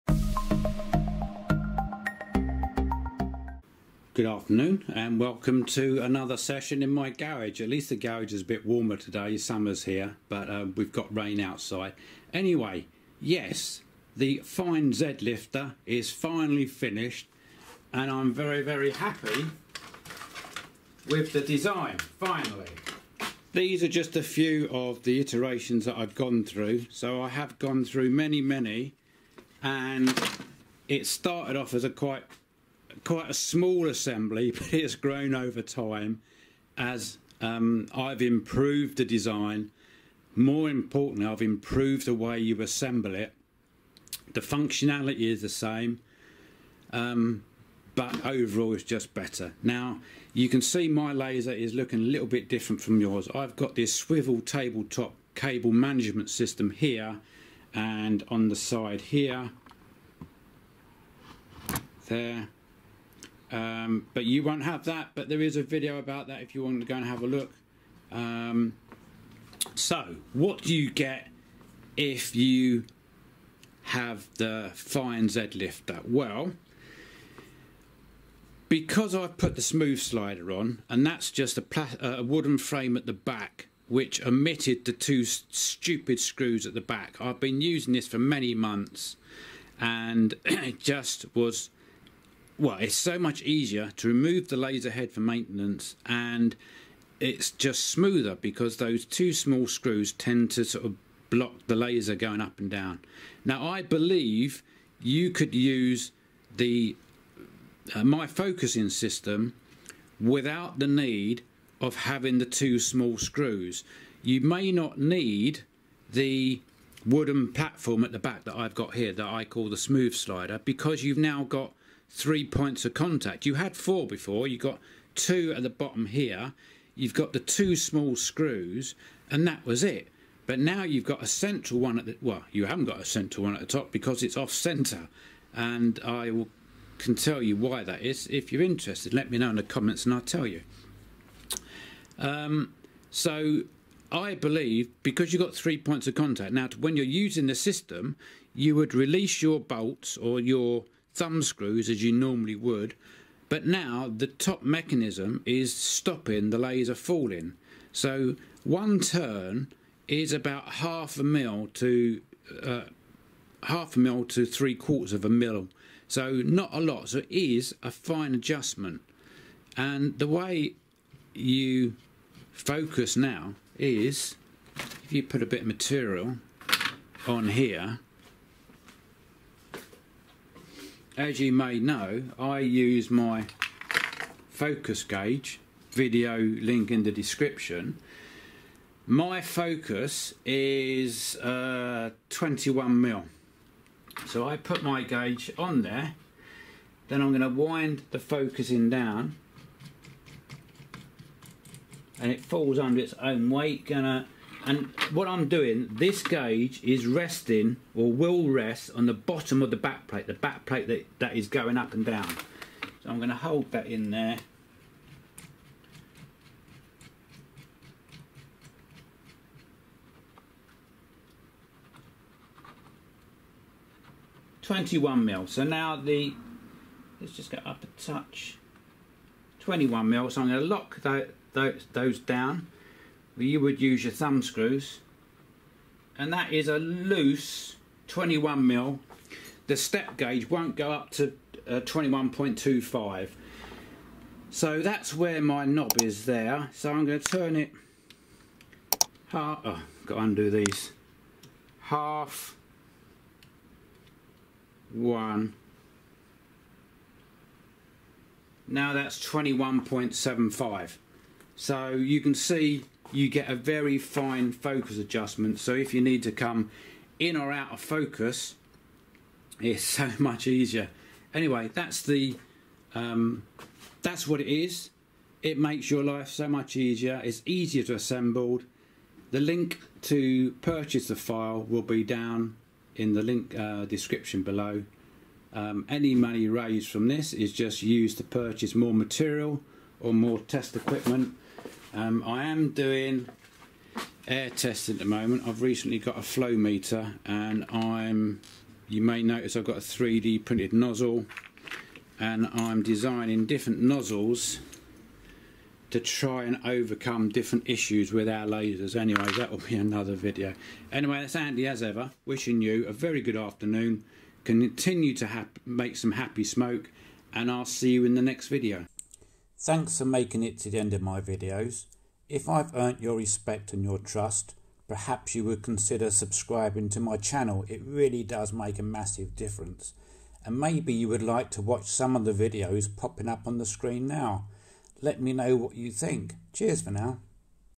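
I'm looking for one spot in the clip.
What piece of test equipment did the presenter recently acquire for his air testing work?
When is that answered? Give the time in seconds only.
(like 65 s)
296 s.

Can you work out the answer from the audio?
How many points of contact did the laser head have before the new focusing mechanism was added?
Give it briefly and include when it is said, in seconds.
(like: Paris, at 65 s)
4, at 123 s.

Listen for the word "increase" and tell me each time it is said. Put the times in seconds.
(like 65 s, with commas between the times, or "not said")
not said.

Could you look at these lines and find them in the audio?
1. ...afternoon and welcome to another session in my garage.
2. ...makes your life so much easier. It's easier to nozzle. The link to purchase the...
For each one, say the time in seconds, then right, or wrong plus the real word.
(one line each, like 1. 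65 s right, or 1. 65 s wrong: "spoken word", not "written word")
1. 4 s right
2. 275 s wrong: "assemble", not "nozzle".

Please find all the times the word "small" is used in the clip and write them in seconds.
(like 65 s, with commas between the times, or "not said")
33 s, 99 s, 112 s, 127 s.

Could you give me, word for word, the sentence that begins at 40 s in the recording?
More importantly, I've improved the way you assemble it.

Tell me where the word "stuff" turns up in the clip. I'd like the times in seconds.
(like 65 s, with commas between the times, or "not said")
not said.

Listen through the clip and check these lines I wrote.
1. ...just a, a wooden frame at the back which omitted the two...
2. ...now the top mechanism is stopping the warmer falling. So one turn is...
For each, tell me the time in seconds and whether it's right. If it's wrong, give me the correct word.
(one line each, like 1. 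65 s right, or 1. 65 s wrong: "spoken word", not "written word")
1. 81 s right
2. 153 s wrong: "laser", not "warmer".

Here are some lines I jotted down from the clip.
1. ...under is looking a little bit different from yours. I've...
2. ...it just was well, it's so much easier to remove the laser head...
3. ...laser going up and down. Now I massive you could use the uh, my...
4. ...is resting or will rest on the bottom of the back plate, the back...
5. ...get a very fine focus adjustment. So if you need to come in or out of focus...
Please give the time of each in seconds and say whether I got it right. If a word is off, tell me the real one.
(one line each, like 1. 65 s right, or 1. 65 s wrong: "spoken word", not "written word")
1. 51 s wrong: "laser", not "under"
2. 90 s right
3. 101 s wrong: "believe", not "massive"
4. 206 s right
5. 263 s right.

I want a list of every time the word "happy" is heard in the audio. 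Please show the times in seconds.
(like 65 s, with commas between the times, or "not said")
18 s, 316 s.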